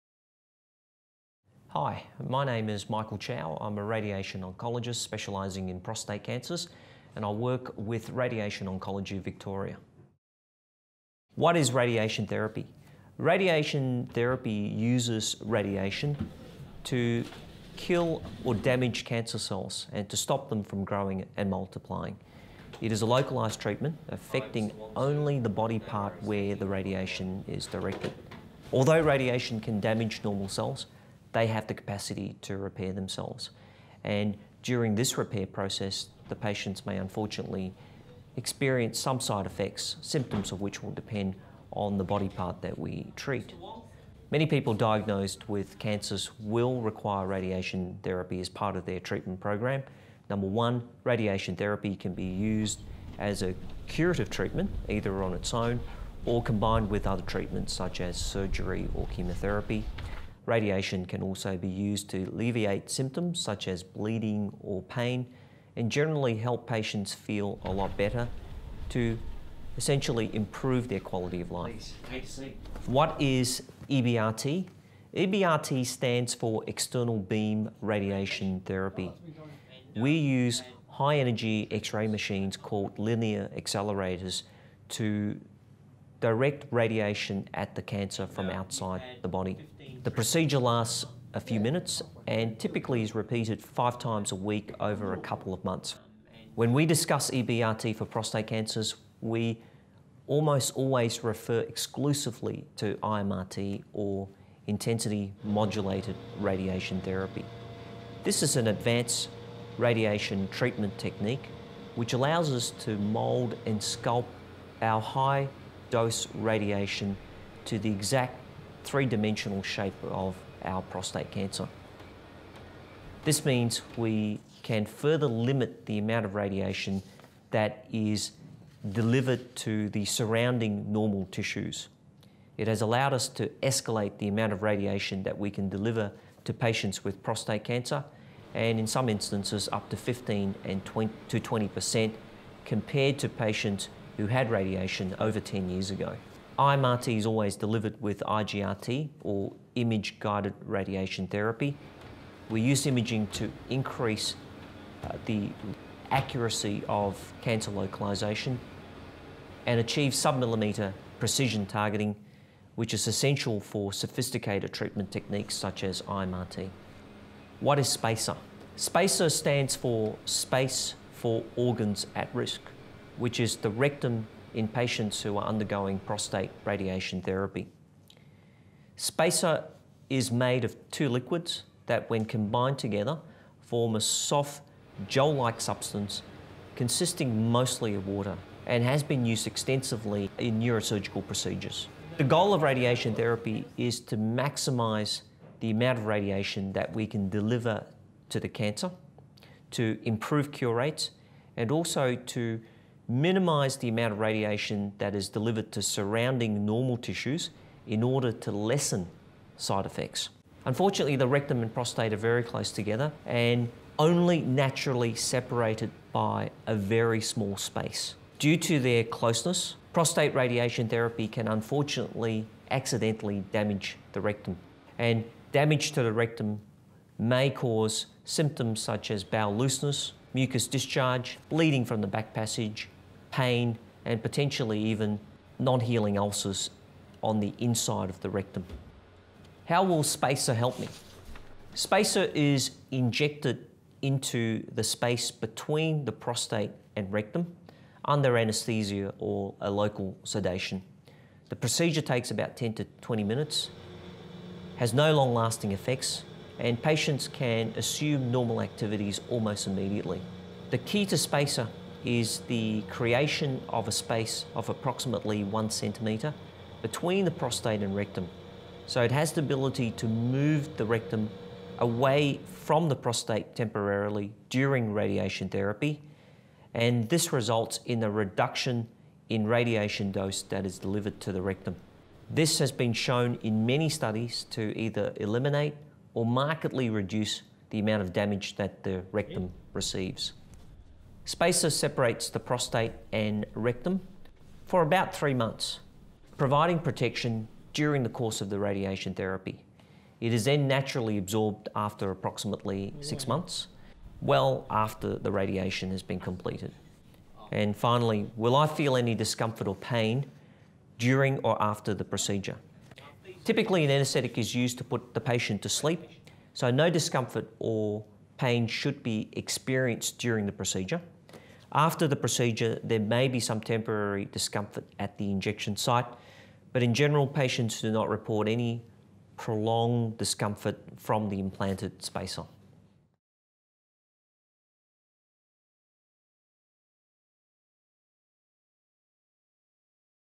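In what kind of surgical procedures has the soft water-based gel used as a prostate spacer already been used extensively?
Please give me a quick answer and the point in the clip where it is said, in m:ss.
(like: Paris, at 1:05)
neurosurgical, at 3:10.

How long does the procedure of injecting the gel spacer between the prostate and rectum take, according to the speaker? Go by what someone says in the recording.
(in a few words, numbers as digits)
10 to 20 minutes.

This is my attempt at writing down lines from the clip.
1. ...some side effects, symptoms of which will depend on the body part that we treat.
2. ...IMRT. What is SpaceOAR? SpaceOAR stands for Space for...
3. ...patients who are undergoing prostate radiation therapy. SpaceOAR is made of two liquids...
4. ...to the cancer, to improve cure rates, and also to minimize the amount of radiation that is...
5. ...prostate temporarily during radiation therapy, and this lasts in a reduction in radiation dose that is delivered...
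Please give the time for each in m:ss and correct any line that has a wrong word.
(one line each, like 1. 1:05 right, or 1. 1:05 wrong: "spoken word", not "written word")
1. 0:38 right
2. 2:46 right
3. 2:54 right
4. 3:18 right
5. 4:32 wrong: "results", not "lasts".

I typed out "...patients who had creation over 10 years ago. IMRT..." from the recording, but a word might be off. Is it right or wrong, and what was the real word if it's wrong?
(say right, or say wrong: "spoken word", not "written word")
wrong: "radiation", not "creation".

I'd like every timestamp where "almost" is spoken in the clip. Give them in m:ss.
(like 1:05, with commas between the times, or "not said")
1:40, 4:19.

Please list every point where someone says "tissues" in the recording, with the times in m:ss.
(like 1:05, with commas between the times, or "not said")
2:11, 3:26.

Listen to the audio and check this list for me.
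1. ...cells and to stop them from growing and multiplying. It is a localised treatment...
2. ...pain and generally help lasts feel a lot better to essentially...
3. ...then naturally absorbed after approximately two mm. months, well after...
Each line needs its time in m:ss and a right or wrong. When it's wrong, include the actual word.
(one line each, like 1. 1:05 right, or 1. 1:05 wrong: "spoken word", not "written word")
1. 0:19 right
2. 1:04 wrong: "patients", not "lasts"
3. 5:00 wrong: "six", not "two".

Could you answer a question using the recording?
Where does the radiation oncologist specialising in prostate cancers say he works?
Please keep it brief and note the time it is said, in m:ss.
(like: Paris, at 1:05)
Radiation Oncology Victoria, at 0:08.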